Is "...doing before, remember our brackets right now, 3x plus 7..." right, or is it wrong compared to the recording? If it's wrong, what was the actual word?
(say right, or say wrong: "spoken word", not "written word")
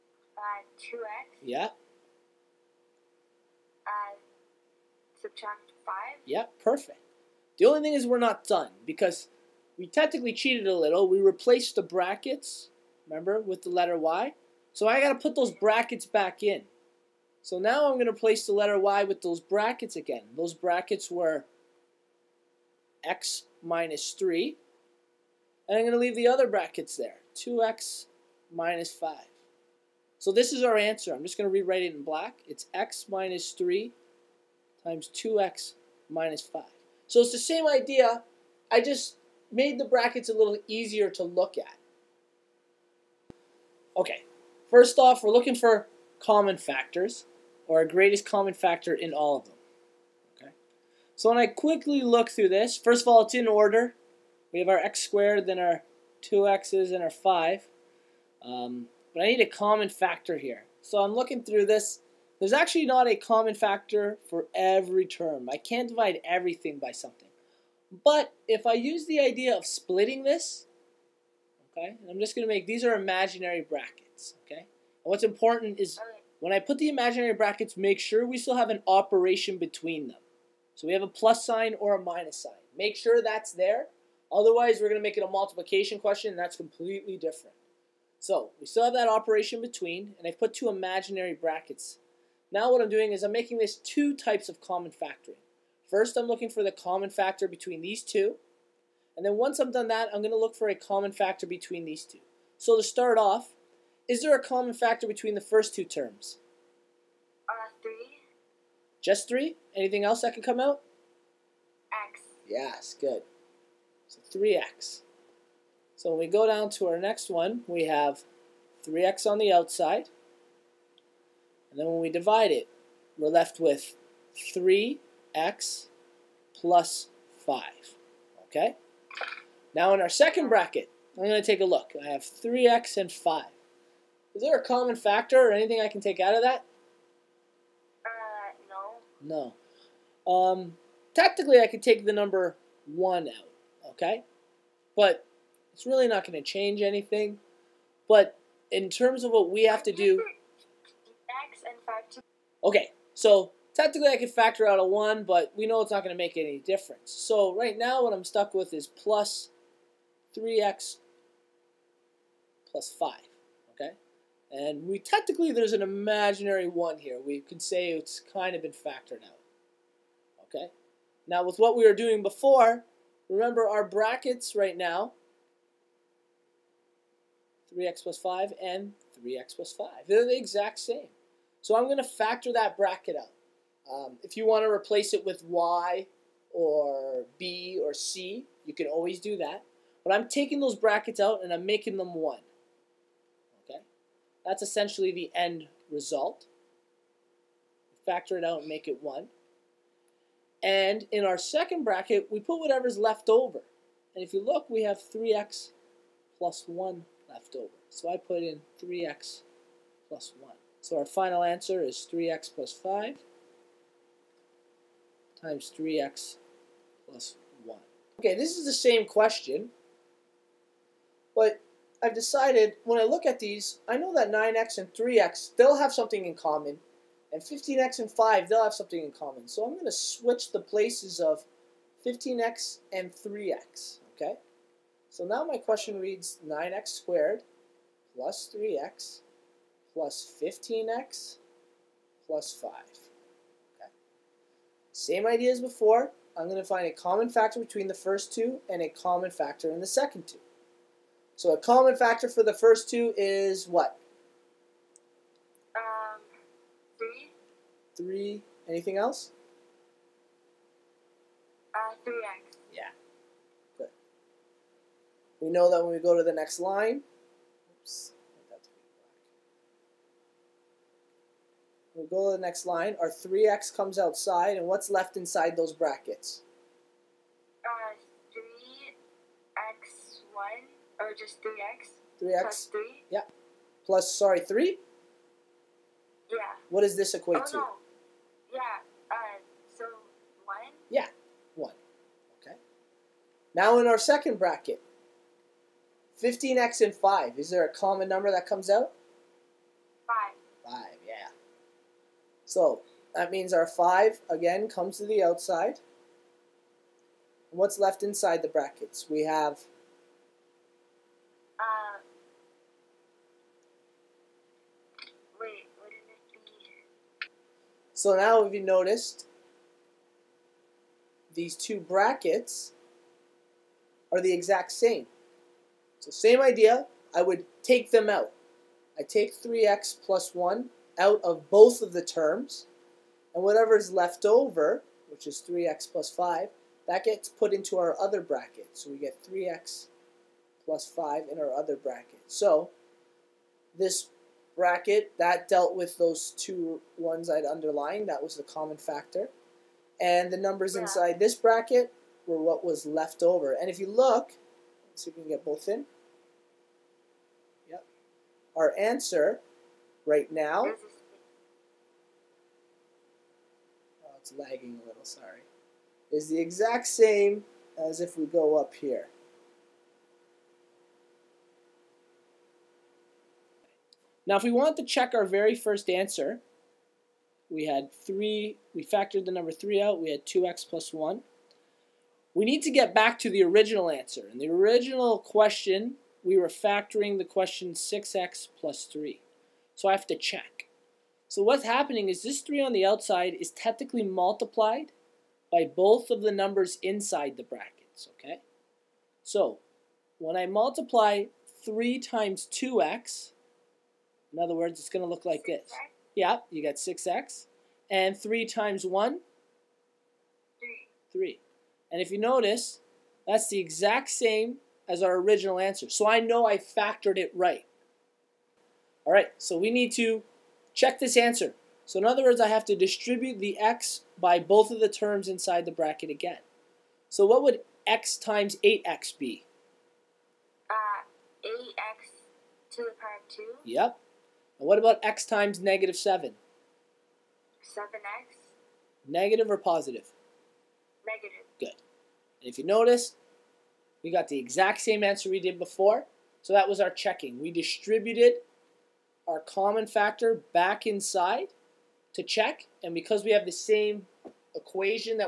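wrong: "5", not "7".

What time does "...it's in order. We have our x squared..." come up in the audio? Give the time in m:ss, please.
0:53.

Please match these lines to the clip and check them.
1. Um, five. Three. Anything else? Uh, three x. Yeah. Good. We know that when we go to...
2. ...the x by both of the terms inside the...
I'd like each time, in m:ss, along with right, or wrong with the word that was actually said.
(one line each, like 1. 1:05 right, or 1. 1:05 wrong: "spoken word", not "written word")
1. 4:15 wrong: "three", not "five"
2. 7:03 right.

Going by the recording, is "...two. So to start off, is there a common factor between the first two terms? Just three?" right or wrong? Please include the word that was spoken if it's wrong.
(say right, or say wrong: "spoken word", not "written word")
right.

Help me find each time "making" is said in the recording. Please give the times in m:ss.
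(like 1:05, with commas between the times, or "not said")
1:33, 3:11.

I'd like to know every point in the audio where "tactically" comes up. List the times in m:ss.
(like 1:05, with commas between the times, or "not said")
2:21, 2:33.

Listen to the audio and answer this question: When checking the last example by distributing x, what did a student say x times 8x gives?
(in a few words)
8x².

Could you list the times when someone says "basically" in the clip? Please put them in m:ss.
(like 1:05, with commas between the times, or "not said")
not said.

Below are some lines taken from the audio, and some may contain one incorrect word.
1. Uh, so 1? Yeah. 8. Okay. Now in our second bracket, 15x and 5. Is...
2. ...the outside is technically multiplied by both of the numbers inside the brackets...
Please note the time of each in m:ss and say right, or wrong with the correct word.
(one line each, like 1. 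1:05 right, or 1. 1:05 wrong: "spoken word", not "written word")
1. 4:49 wrong: "1", not "8"
2. 6:32 right.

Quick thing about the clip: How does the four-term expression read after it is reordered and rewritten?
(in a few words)
9x² + 3x + 15x + 5.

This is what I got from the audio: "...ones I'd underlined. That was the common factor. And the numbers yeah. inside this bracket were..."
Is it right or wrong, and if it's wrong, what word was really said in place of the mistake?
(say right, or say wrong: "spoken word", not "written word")
right.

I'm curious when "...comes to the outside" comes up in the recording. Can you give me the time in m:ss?
5:04.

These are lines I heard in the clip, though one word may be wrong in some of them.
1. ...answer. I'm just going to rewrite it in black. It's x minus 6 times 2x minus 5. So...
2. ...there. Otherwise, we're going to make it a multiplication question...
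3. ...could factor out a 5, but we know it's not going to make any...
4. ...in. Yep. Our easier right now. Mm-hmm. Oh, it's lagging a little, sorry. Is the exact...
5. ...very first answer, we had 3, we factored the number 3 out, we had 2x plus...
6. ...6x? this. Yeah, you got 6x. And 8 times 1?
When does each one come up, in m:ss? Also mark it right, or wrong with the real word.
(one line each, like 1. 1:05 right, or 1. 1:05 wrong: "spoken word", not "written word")
1. 0:30 wrong: "3", not "6"
2. 1:23 right
3. 2:34 wrong: "1", not "5"
4. 5:55 wrong: "answer", not "easier"
5. 6:15 right
6. 6:45 wrong: "3", not "8".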